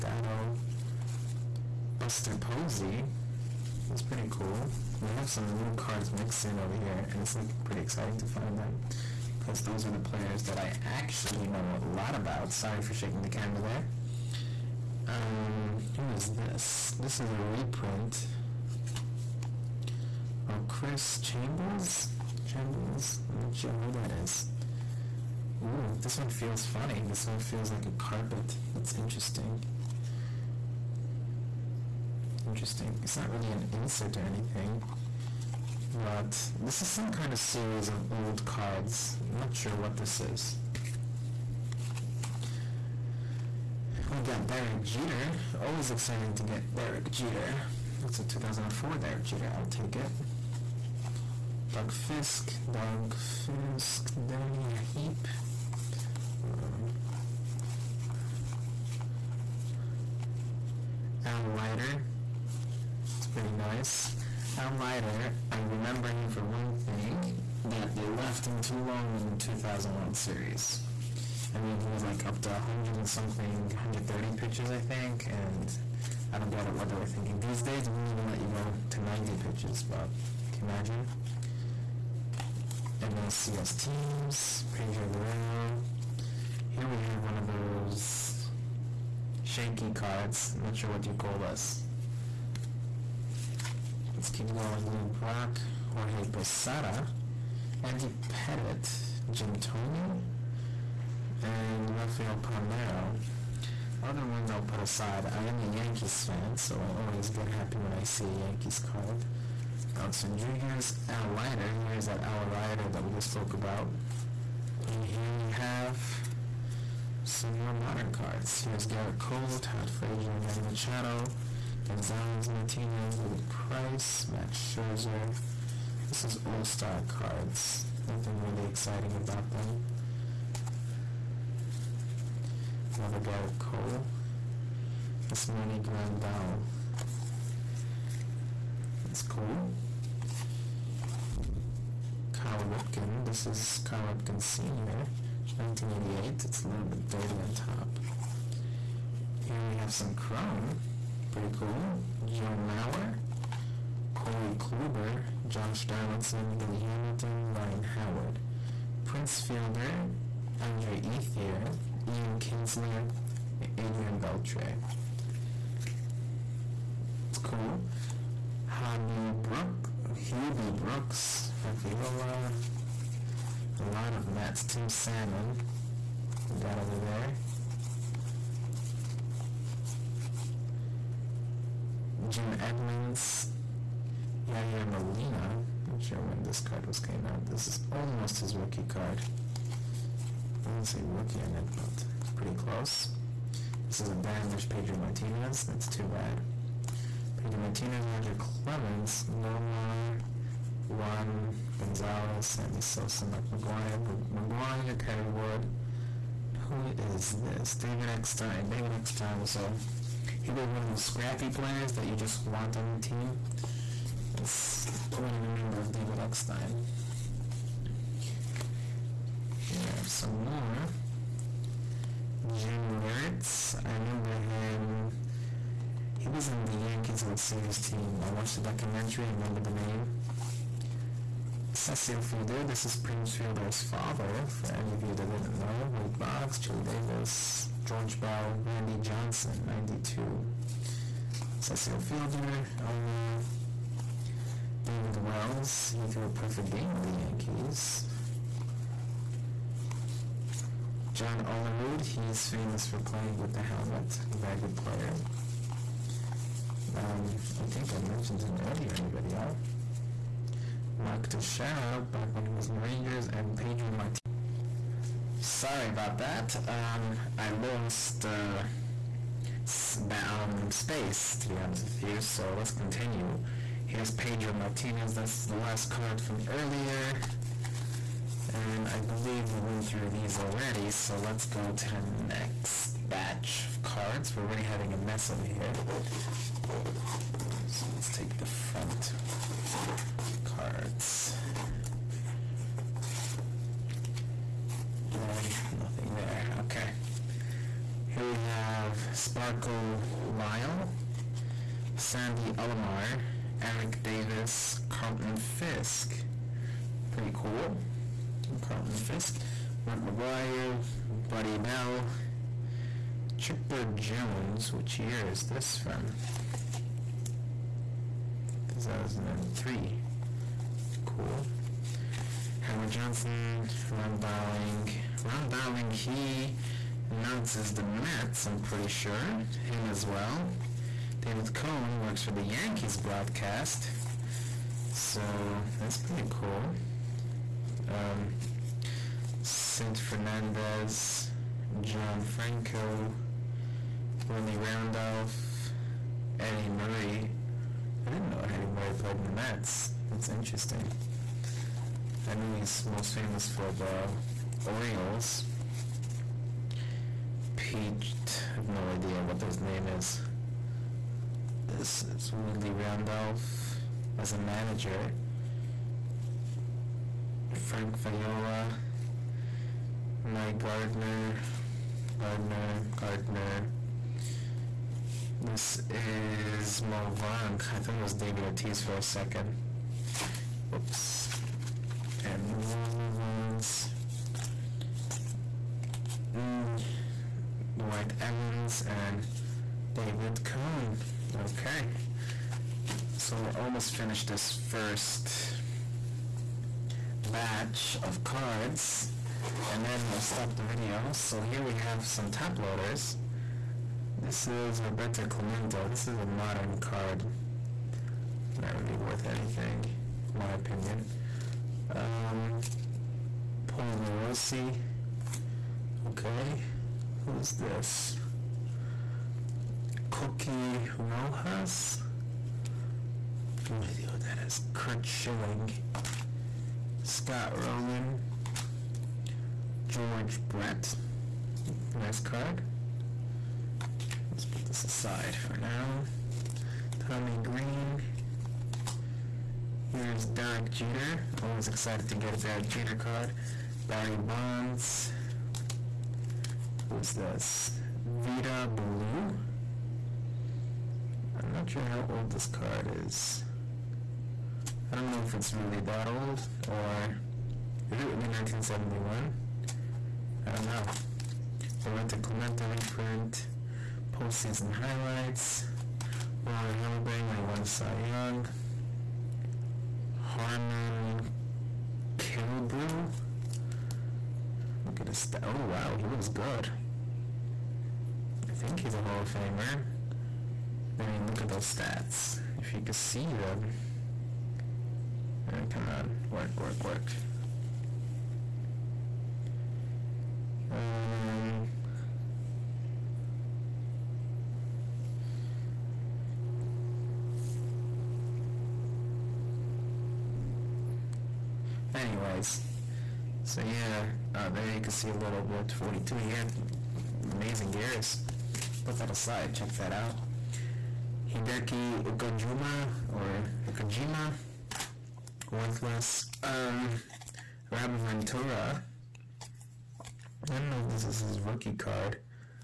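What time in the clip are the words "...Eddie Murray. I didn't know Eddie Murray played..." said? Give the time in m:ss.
5:46.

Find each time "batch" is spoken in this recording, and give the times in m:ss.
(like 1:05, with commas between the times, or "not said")
4:43, 6:37.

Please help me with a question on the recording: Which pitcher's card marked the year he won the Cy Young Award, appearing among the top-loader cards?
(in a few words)
Roy Halladay.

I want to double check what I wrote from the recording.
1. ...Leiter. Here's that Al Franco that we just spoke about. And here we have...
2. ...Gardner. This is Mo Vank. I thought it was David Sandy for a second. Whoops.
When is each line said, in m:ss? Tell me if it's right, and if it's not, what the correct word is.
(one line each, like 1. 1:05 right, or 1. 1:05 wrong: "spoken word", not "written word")
1. 1:51 wrong: "Leiter", not "Franco"
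2. 6:12 wrong: "Ortiz", not "Sandy".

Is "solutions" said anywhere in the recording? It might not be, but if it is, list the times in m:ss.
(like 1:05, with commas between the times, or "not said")
not said.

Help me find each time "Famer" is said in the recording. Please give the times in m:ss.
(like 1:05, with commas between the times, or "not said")
7:59.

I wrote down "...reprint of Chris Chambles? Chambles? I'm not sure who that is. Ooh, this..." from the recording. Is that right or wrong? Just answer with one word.
right.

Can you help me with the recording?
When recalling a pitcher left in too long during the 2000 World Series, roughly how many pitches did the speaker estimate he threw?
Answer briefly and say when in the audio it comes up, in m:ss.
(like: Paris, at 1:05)
130, at 1:13.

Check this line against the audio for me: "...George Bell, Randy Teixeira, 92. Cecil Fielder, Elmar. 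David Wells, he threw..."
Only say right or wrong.
wrong.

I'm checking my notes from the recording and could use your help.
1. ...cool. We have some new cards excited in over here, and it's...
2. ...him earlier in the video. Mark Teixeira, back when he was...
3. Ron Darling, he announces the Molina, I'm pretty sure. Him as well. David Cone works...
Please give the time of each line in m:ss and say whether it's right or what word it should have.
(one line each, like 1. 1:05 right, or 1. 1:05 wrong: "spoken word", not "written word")
1. 0:04 wrong: "mixed", not "excited"
2. 4:18 right
3. 5:25 wrong: "Mets", not "Molina".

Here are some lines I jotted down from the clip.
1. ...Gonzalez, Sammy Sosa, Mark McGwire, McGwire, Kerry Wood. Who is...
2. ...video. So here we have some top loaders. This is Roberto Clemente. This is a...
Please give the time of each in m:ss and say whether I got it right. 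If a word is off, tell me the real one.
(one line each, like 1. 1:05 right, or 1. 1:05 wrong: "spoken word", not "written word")
1. 3:21 right
2. 6:40 right.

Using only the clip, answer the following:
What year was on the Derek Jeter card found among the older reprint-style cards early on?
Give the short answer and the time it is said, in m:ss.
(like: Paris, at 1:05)
2004, at 0:48.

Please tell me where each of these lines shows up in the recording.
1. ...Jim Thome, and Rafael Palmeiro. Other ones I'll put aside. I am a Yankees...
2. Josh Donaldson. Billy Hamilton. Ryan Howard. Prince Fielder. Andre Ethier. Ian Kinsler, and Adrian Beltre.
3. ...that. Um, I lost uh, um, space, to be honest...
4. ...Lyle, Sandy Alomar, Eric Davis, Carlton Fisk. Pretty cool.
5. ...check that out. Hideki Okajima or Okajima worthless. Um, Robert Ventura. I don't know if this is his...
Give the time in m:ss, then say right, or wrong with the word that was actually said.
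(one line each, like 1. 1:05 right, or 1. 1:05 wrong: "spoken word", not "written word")
1. 1:39 right
2. 2:35 right
3. 4:26 right
4. 5:00 right
5. 8:29 right.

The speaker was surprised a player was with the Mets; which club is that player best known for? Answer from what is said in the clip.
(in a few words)
Orioles.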